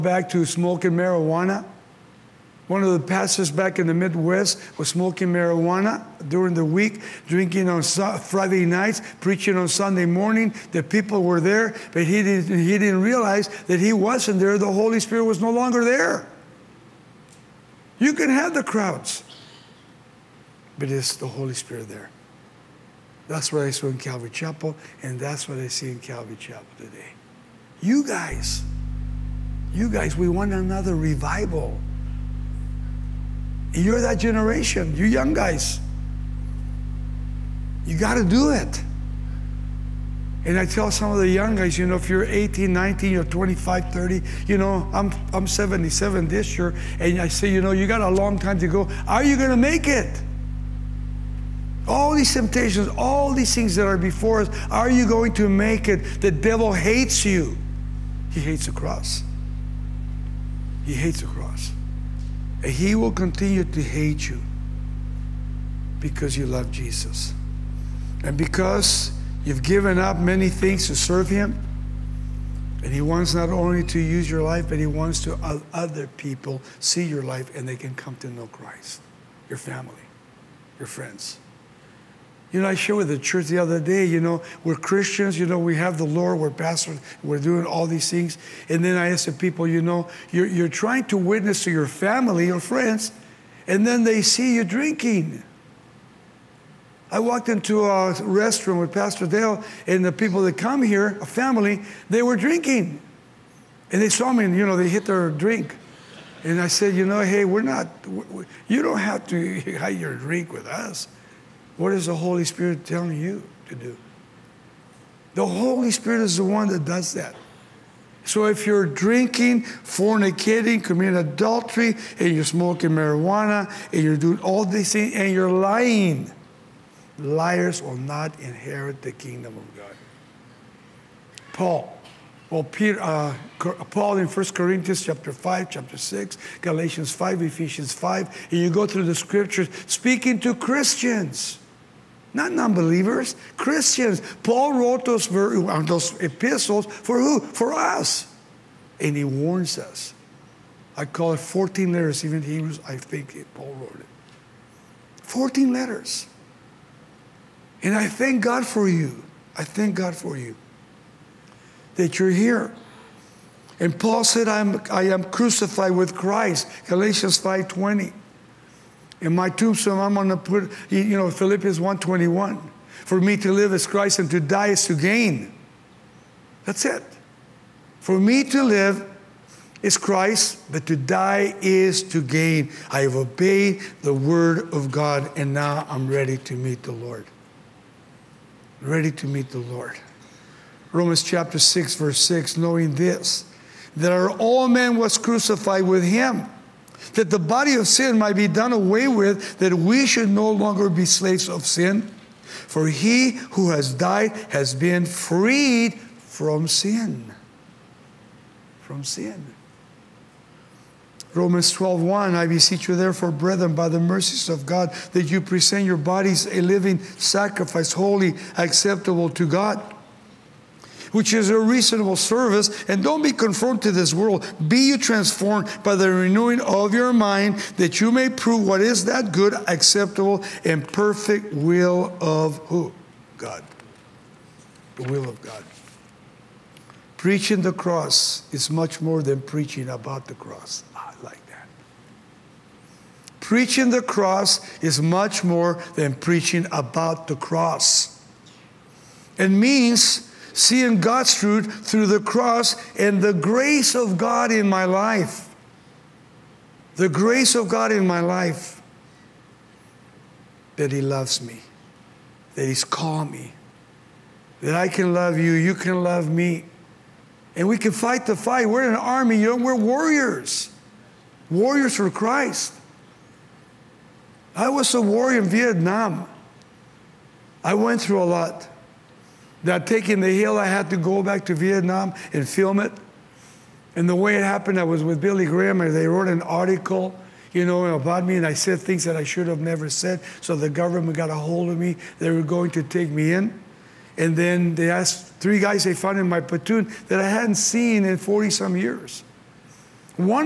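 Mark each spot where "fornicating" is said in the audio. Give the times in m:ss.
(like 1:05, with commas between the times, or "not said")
1:59.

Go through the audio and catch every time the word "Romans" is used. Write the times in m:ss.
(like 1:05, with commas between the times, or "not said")
3:10, 3:31.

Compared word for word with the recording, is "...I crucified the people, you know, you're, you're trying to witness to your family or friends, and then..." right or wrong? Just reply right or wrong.
wrong.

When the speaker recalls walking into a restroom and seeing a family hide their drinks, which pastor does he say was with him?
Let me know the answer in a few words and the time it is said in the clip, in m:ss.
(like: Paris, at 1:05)
Pastor Dale, at 1:38.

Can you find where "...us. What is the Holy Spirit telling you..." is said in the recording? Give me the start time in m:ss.
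1:50.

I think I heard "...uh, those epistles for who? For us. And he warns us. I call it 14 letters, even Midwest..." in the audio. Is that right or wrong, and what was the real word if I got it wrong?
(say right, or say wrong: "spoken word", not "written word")
wrong: "Hebrews", not "Midwest".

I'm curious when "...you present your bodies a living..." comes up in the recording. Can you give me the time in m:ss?
3:35.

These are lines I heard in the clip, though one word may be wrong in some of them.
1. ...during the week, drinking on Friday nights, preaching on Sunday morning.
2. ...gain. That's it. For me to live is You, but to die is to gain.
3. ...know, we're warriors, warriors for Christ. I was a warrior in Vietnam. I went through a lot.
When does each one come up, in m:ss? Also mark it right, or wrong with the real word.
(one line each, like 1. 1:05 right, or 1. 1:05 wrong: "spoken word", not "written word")
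1. 0:06 right
2. 2:54 wrong: "Christ", not "You"
3. 4:29 right.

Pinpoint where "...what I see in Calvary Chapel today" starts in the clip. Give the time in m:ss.
0:25.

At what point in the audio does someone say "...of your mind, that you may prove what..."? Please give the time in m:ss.
3:46.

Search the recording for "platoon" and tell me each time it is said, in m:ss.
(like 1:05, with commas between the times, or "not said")
4:56.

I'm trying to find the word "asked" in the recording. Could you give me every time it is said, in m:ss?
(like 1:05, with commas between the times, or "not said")
1:29, 4:54.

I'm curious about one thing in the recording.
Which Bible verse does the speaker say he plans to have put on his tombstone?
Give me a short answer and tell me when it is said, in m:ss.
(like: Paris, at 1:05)
Philippians 1:21, at 2:51.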